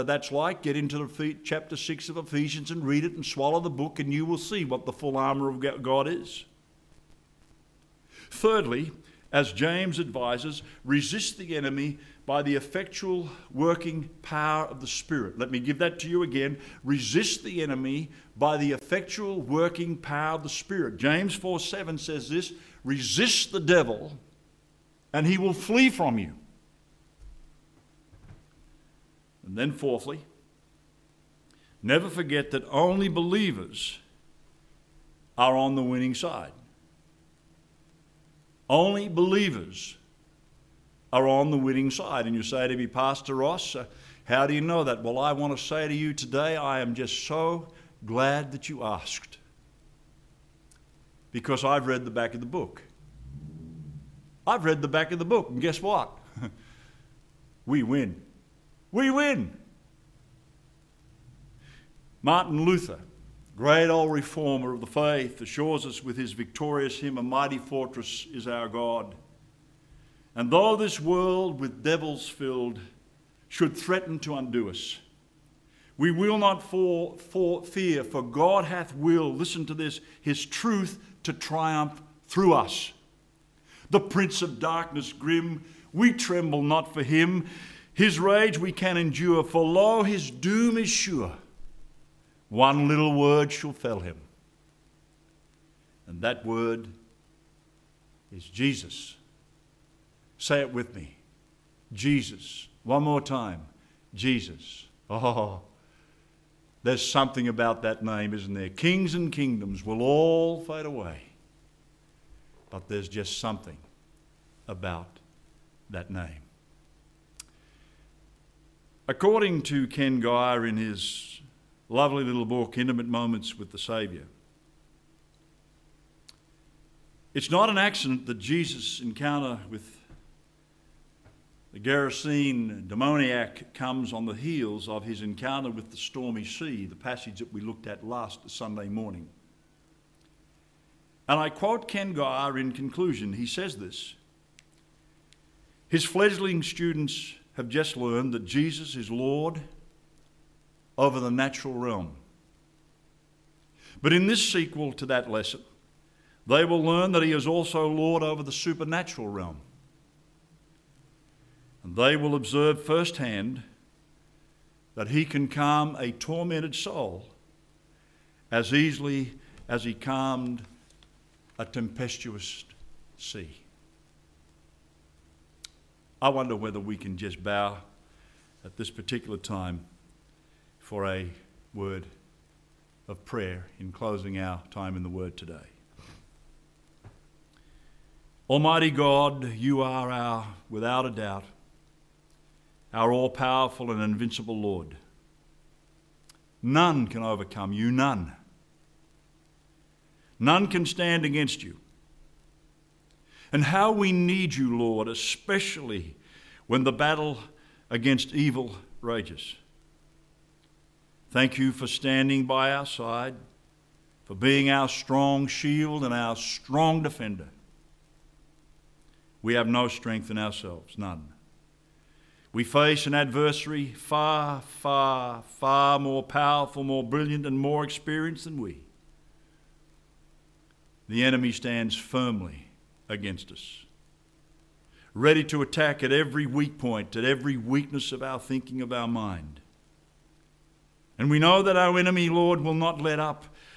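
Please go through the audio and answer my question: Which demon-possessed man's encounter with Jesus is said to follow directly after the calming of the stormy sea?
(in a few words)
Gerasene demoniac.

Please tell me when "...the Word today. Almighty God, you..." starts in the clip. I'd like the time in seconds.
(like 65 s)
185 s.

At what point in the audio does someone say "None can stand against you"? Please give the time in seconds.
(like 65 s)
200 s.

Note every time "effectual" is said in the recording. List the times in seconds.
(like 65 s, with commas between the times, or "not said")
12 s, 18 s.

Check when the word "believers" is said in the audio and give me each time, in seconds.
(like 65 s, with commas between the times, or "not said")
33 s, 39 s.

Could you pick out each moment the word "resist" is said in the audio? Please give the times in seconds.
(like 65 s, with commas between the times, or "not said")
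10 s, 16 s, 22 s.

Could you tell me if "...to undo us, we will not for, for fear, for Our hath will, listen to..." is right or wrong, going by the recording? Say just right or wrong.
wrong.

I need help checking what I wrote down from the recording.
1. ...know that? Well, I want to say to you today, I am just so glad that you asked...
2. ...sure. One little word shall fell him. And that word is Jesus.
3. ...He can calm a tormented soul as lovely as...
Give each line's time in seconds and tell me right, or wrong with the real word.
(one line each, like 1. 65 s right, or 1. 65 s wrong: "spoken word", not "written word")
1. 44 s right
2. 90 s right
3. 165 s wrong: "easily", not "lovely".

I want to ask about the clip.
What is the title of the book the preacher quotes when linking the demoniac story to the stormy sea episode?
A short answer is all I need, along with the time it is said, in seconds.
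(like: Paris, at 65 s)
Intimate Moments with the Saviour, at 122 s.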